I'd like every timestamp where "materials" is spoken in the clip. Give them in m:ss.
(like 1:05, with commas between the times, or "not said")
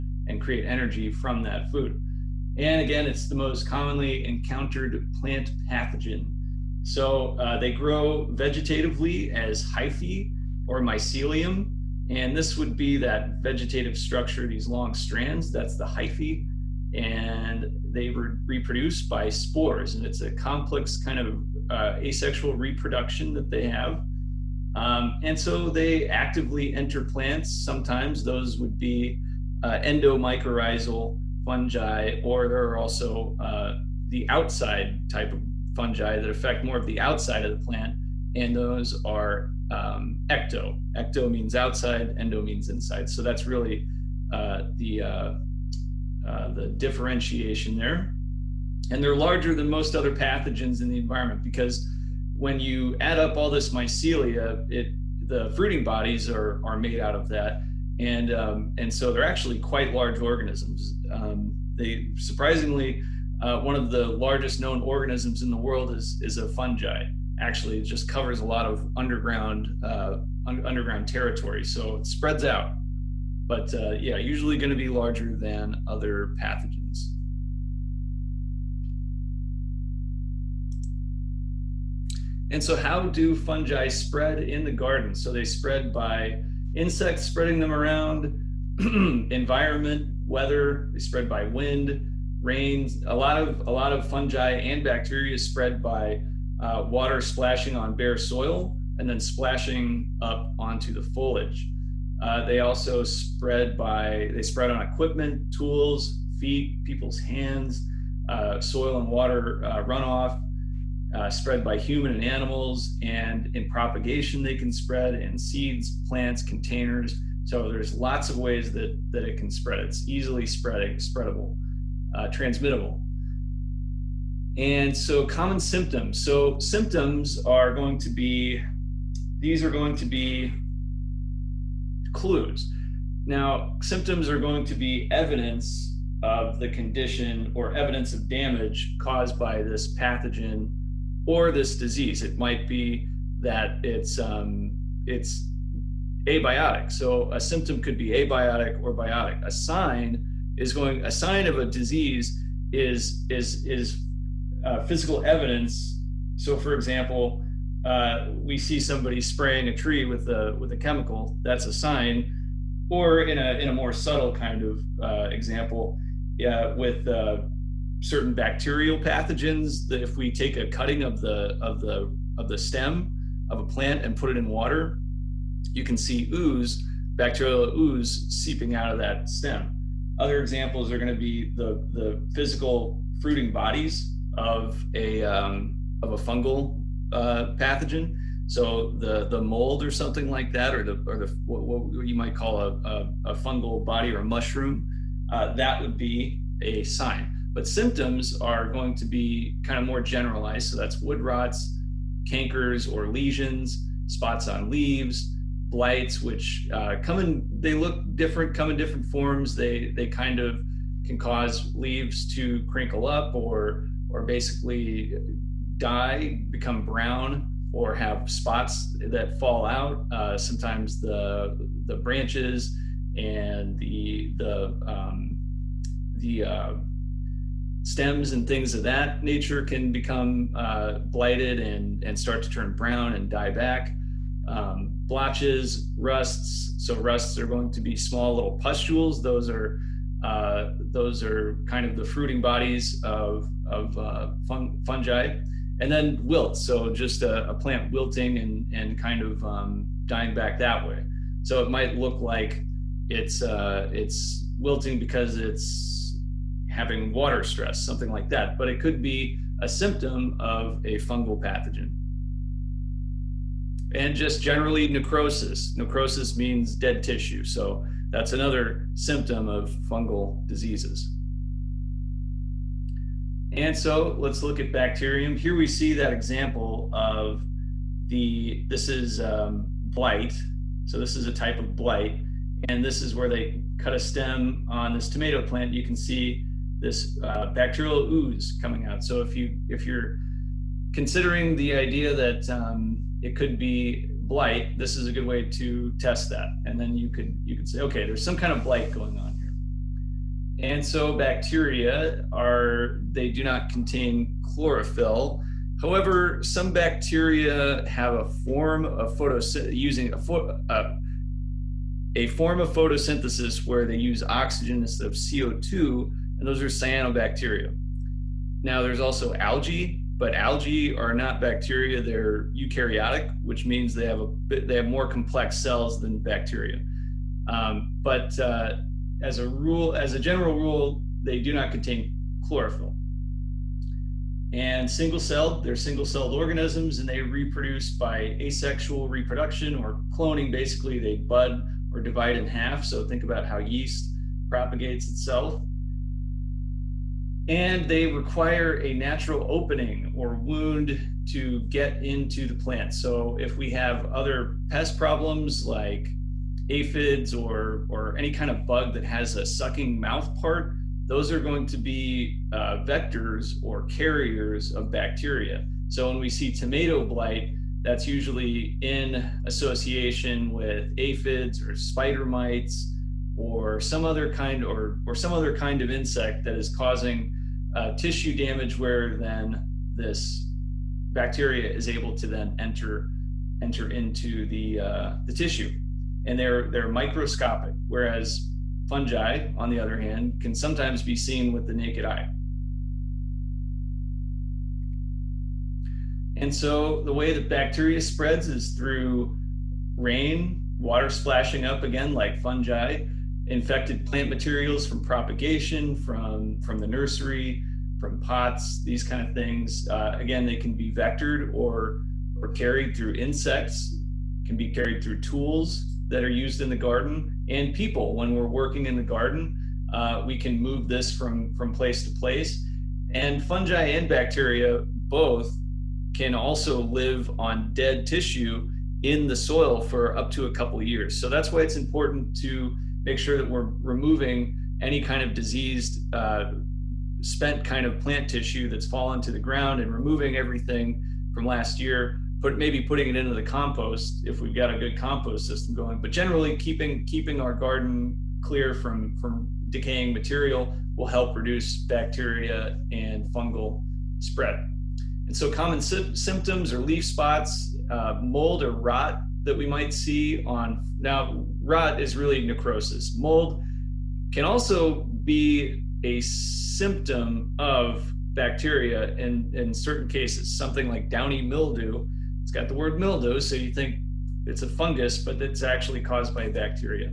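6:44, 7:30.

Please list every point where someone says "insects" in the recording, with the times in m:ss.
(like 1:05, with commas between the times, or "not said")
1:26, 6:15, 6:53.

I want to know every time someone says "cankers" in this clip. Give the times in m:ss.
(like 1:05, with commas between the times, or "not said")
3:22.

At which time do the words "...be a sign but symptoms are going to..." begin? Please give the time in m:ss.
3:15.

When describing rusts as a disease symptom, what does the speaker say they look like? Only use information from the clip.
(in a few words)
small little pustules.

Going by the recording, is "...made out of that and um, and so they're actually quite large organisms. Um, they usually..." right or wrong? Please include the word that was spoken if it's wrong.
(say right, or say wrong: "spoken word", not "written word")
wrong: "surprisingly", not "usually".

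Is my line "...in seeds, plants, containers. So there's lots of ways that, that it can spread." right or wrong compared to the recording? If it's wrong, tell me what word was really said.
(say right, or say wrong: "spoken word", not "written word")
right.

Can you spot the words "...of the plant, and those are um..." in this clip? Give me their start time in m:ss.
0:37.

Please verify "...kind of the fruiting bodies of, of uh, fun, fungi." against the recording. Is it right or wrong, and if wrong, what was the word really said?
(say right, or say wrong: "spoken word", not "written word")
right.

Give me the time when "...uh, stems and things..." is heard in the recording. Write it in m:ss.
3:46.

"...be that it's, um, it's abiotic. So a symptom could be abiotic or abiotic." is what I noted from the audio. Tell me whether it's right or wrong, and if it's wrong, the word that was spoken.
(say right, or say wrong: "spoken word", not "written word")
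wrong: "biotic", not "abiotic".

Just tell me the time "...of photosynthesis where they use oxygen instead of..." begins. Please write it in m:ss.
5:12.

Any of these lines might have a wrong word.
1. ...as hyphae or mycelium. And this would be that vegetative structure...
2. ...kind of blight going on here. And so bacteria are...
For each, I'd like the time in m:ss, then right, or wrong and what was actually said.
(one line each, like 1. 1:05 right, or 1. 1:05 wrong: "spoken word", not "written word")
1. 0:09 right
2. 4:58 right.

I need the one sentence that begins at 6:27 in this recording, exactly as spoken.
Whereas fungi, on the other hand, can sometimes be seen with the naked eye.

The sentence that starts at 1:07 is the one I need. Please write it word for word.
Actually, it just covers a lot of underground uh, un underground territory, so it spreads out.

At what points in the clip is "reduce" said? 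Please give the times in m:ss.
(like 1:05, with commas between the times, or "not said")
7:31.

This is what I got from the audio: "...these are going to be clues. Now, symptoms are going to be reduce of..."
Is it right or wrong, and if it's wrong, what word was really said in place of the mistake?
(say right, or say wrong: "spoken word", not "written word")
wrong: "evidence", not "reduce".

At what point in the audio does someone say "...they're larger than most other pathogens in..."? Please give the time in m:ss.
0:49.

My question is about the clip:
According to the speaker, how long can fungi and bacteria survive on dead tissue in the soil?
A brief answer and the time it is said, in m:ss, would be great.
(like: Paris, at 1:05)
up to a couple years, at 7:10.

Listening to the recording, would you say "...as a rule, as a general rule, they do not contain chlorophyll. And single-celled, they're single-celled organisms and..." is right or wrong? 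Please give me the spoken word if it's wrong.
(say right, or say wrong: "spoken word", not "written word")
right.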